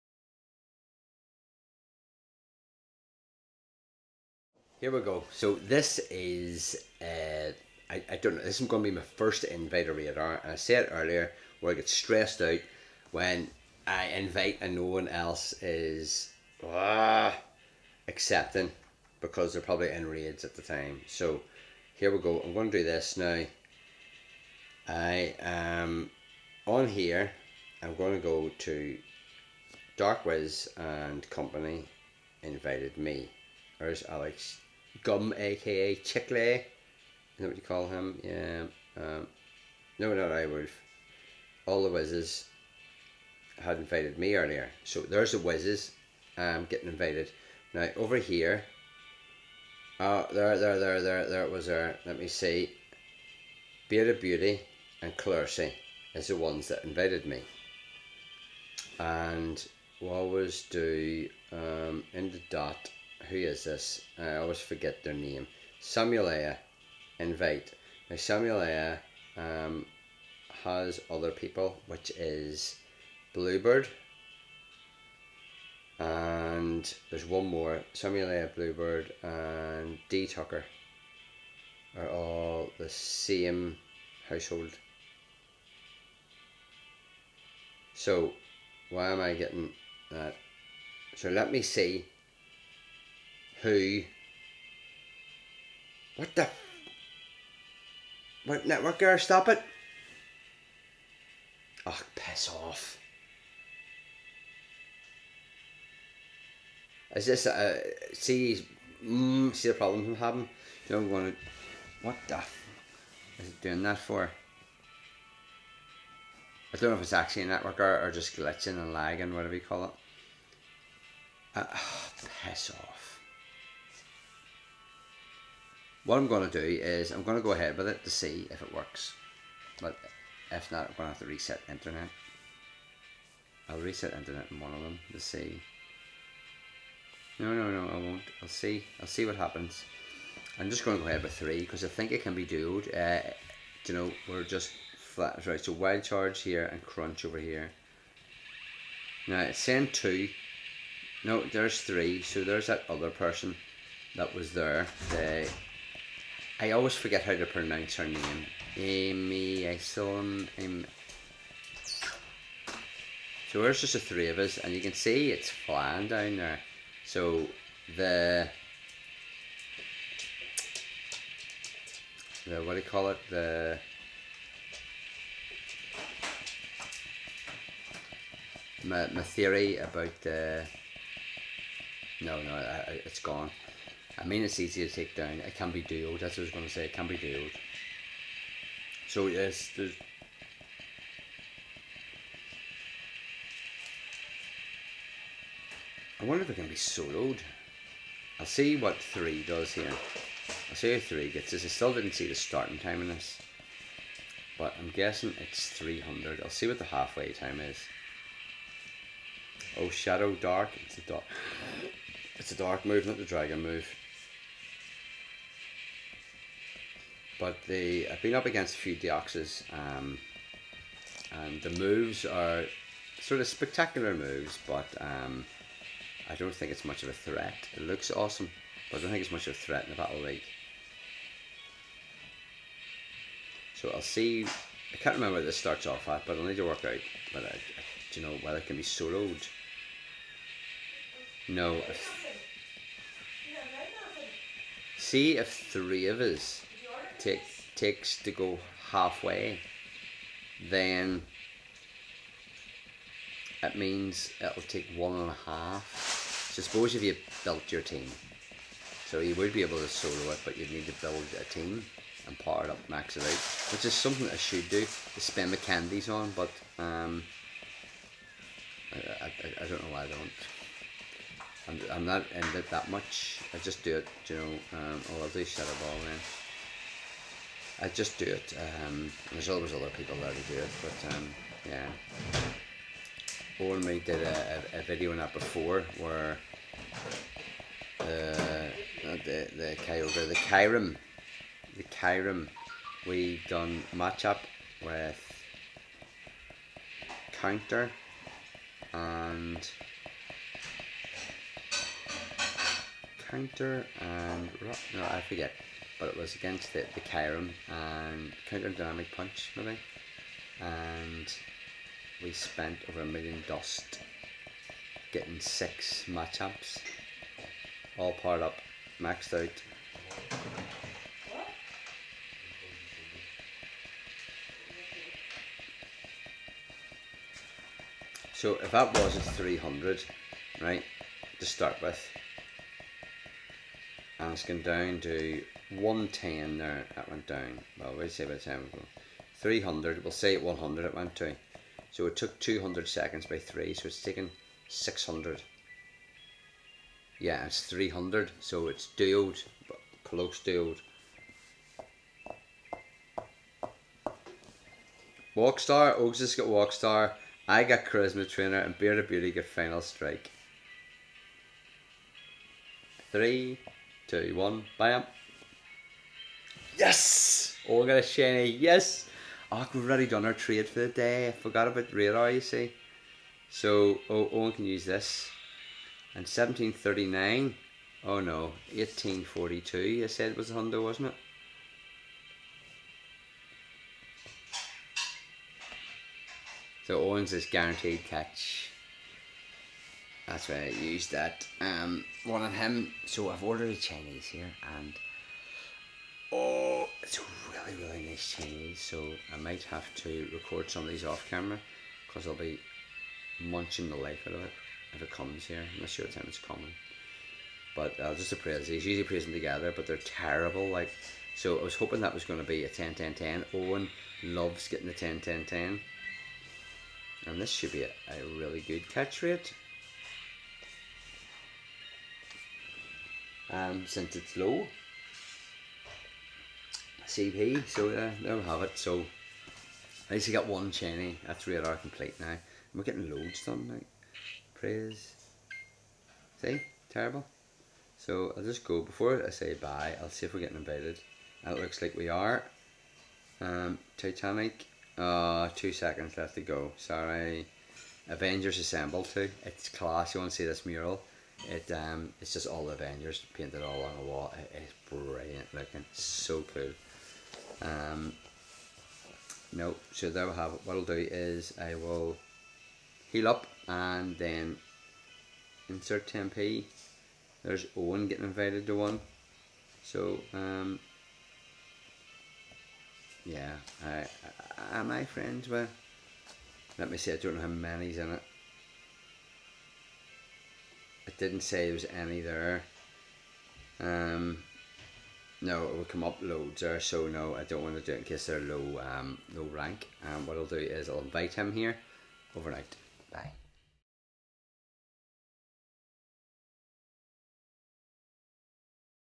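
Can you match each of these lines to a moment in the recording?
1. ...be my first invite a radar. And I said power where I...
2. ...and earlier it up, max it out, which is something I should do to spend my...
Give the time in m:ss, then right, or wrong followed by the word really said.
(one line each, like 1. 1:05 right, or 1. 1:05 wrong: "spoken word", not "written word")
1. 0:08 wrong: "earlier", not "power"
2. 4:22 wrong: "power", not "earlier".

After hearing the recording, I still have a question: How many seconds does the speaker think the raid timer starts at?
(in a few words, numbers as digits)
300.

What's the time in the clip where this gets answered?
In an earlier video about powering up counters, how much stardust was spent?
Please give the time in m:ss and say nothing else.
5:12.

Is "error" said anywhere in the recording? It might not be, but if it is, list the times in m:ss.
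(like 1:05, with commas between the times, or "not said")
1:39.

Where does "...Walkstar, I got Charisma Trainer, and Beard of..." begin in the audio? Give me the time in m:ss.
5:56.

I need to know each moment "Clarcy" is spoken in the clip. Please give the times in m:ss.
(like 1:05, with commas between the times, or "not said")
0:55.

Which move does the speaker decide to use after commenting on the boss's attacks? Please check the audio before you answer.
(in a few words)
Shadow Ball.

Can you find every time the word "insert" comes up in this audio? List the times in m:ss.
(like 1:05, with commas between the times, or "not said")
7:45.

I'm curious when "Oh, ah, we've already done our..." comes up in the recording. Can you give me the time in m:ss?
6:09.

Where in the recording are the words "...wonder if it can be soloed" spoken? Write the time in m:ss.
3:16.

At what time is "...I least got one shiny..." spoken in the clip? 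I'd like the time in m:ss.
7:10.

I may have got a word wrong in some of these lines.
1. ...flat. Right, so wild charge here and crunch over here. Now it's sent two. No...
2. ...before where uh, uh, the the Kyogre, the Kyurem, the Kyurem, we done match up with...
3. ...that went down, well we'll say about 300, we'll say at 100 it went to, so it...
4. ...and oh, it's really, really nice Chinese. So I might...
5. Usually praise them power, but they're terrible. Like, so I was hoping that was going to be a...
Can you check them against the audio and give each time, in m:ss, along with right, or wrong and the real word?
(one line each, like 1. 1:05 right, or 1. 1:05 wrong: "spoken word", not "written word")
1. 2:24 right
2. 4:45 right
3. 5:36 right
4. 6:34 right
5. 6:48 wrong: "together", not "power".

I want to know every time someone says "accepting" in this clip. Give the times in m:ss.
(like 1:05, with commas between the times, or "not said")
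0:18.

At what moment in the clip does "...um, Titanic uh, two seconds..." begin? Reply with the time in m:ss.
7:23.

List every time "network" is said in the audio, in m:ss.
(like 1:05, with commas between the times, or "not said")
1:38, 1:57.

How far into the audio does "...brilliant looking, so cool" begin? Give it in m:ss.
7:34.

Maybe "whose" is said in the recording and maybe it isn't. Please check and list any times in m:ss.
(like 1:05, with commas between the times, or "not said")
not said.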